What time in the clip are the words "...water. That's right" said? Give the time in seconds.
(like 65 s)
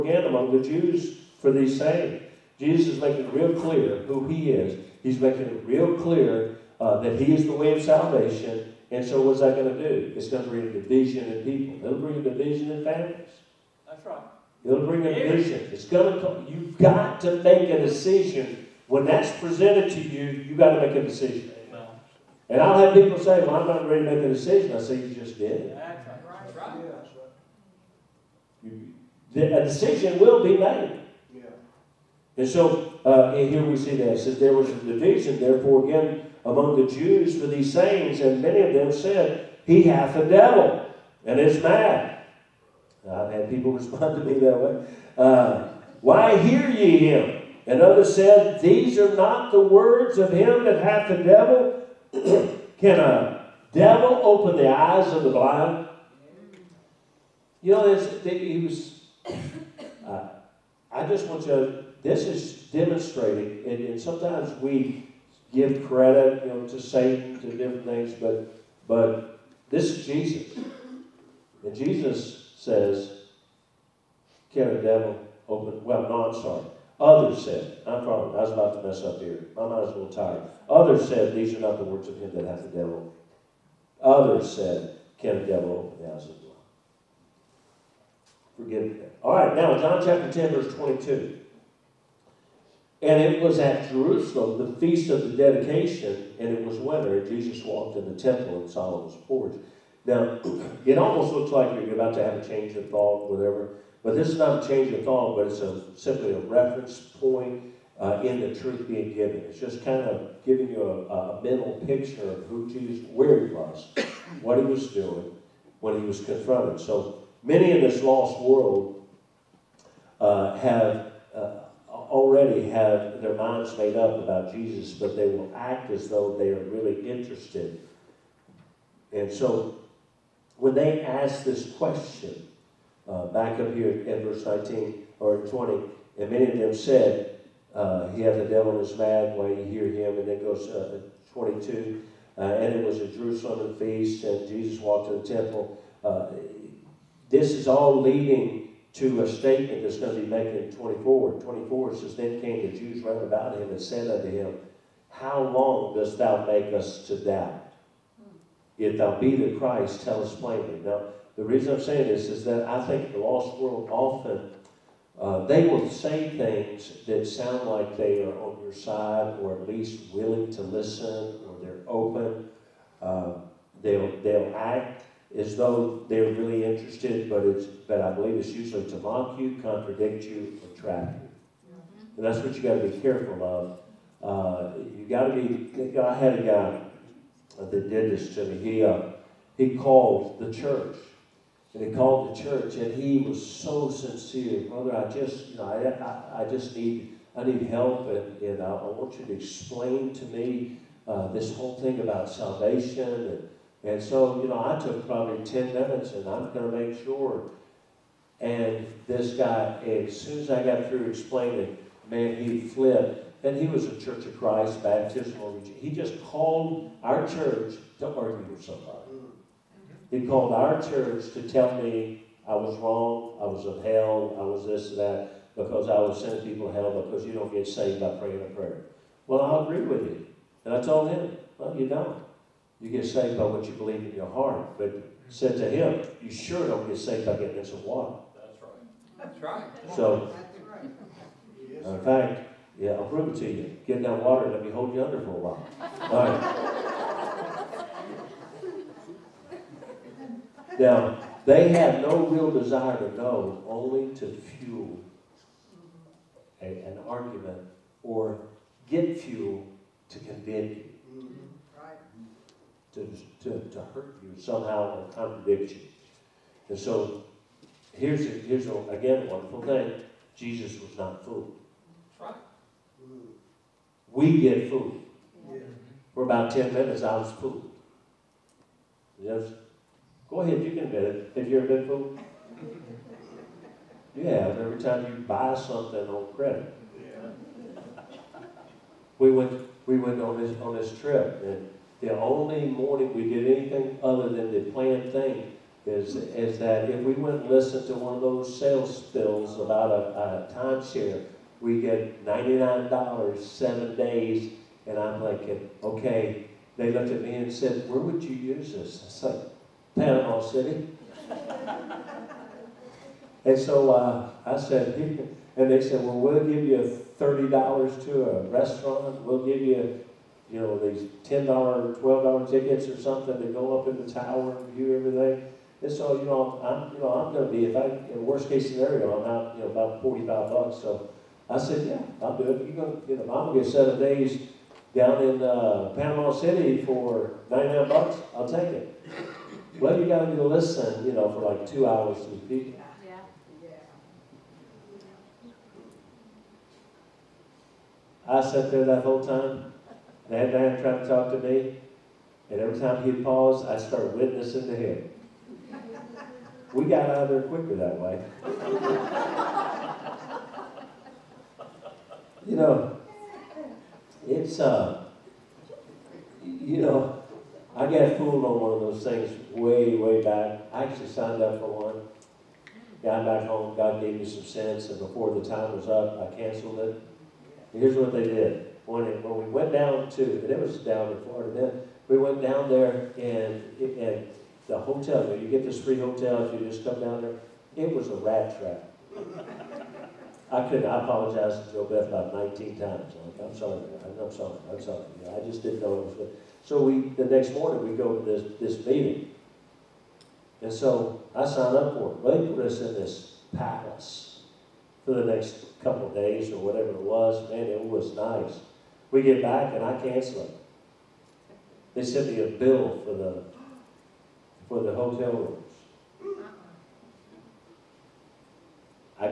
237 s.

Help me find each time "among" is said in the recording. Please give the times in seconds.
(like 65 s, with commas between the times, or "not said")
0 s, 36 s.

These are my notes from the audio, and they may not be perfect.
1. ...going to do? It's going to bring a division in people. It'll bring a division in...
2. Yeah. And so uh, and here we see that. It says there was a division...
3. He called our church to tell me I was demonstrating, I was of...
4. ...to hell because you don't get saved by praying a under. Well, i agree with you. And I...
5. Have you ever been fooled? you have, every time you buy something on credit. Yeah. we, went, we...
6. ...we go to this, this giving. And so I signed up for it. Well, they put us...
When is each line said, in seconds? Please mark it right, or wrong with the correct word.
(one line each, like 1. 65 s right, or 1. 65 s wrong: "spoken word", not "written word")
1. 9 s right
2. 31 s right
3. 220 s wrong: "wrong", not "demonstrating"
4. 226 s wrong: "prayer", not "under"
5. 281 s right
6. 397 s wrong: "meeting", not "giving".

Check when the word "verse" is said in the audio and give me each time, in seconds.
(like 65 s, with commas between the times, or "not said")
90 s, 134 s.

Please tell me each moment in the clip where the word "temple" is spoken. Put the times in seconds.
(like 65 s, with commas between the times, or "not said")
98 s, 145 s.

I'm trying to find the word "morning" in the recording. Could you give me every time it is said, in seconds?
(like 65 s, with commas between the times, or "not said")
292 s, 378 s, 397 s.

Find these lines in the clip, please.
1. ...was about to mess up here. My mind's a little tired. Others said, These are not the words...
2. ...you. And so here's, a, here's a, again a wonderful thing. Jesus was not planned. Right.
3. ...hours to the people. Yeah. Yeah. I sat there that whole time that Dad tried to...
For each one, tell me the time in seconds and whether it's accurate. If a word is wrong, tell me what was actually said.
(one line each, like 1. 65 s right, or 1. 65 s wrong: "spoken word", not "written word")
1. 78 s right
2. 265 s wrong: "fooled", not "planned"
3. 341 s right.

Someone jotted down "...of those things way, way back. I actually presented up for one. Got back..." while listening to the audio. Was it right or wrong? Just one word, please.
wrong.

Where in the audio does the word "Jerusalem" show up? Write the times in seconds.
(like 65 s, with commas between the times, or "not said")
93 s, 143 s.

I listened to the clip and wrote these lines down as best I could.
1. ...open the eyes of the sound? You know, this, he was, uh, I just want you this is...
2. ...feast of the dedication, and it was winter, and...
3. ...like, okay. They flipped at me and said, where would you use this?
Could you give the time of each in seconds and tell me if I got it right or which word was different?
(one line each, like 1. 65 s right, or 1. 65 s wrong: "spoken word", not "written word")
1. 54 s wrong: "blind", not "sound"
2. 94 s right
3. 305 s wrong: "looked", not "flipped".